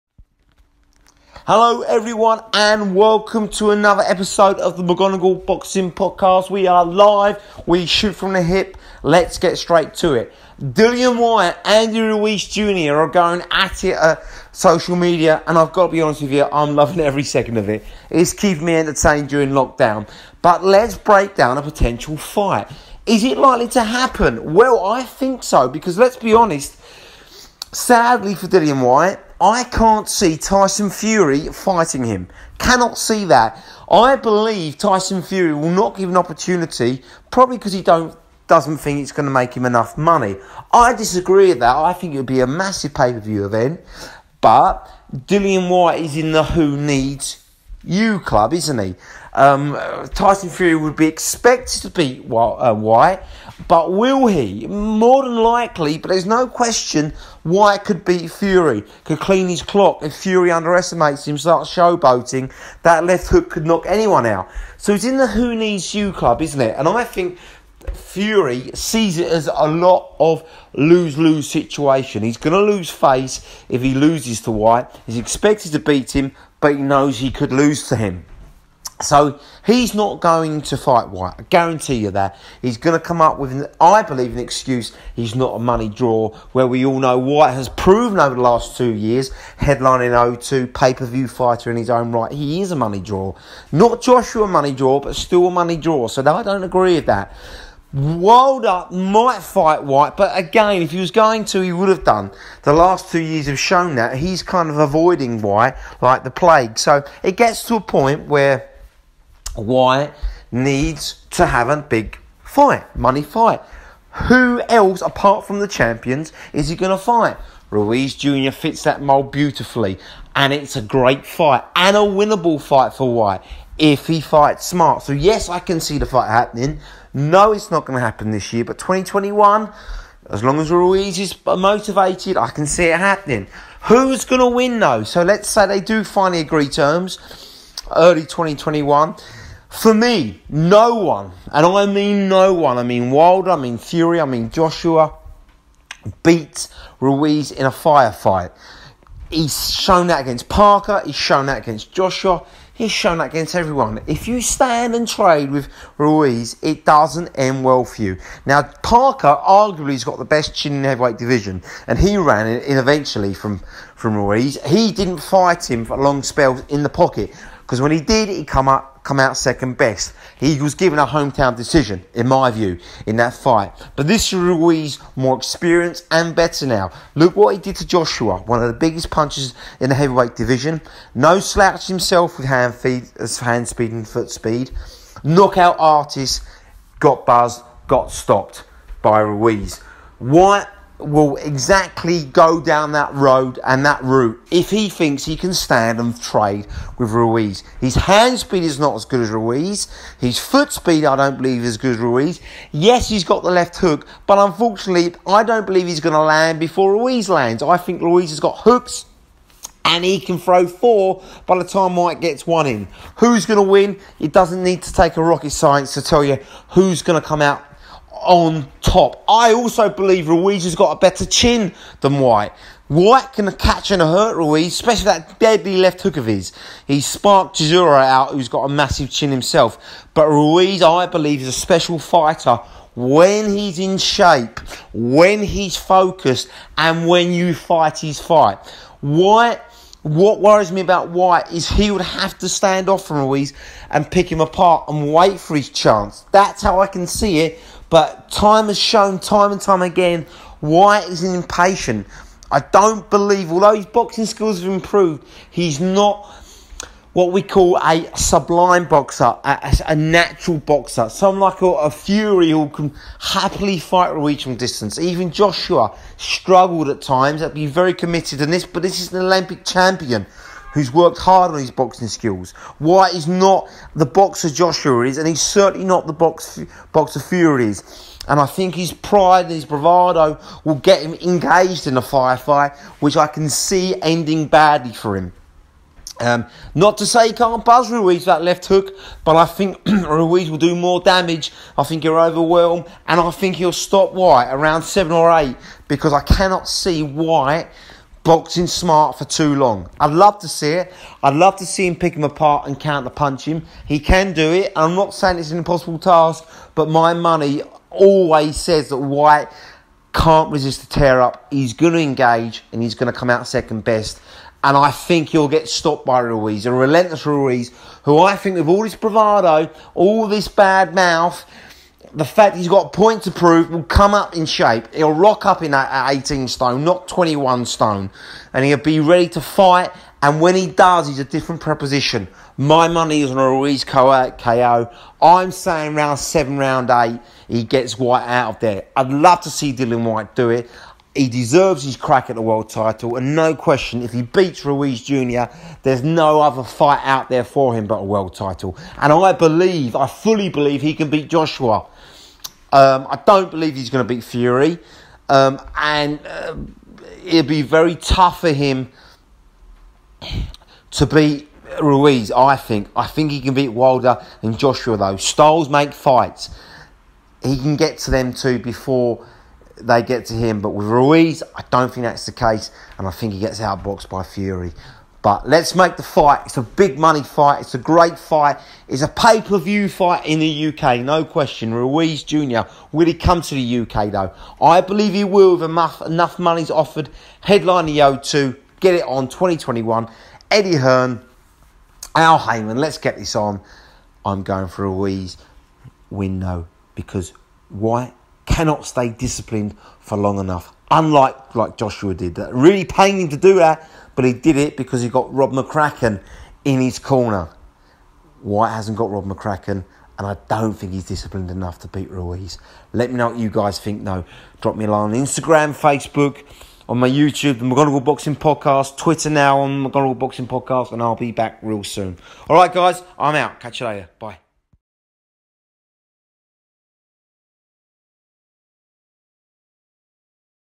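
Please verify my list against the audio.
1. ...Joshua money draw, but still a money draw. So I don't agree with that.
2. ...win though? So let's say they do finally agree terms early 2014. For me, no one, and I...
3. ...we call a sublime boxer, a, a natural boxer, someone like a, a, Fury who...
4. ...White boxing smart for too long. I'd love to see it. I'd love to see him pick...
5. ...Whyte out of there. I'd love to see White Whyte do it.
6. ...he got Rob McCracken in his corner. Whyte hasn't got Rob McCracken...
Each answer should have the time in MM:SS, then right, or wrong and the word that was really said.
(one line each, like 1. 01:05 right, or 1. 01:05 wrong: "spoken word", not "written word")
1. 01:34 right
2. 02:14 wrong: "2021", not "2014"
3. 04:17 right
4. 04:57 right
5. 05:37 wrong: "Dillian", not "White"
6. 06:45 right.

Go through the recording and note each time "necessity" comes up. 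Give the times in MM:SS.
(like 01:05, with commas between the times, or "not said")
not said.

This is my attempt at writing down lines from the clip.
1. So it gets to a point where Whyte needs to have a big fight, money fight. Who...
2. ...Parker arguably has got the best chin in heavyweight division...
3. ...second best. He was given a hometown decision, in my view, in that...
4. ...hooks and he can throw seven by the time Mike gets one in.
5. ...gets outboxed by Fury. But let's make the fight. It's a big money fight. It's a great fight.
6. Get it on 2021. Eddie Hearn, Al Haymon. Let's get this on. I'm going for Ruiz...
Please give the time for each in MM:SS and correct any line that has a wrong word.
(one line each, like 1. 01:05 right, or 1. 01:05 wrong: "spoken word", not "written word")
1. 01:46 right
2. 02:38 right
3. 02:49 right
4. 03:28 wrong: "four", not "seven"
5. 06:13 right
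6. 06:28 right.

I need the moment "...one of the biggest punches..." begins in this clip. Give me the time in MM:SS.
02:58.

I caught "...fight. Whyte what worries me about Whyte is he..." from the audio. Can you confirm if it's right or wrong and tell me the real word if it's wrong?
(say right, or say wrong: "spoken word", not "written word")
right.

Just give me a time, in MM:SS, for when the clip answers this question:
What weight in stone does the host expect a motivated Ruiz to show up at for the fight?
05:26.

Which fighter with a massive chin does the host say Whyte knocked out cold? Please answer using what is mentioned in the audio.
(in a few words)
Chisora.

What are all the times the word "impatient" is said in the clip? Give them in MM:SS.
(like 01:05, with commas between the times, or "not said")
04:11.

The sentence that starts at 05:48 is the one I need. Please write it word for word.
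And I believe, I fully believe he can beat Joshua.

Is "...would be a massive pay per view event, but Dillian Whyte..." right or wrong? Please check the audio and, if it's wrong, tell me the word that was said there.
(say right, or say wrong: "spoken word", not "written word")
right.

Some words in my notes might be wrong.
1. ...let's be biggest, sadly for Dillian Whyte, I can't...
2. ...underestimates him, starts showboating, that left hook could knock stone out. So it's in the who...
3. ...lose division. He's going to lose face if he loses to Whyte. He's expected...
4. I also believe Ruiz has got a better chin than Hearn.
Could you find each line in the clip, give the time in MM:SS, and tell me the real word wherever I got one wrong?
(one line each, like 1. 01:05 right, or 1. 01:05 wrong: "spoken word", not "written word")
1. 00:25 wrong: "honest", not "biggest"
2. 01:00 wrong: "anyone", not "stone"
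3. 01:11 wrong: "situation", not "division"
4. 03:39 wrong: "Whyte", not "Hearn".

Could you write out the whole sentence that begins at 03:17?
His hand speed is not as good as Ruiz.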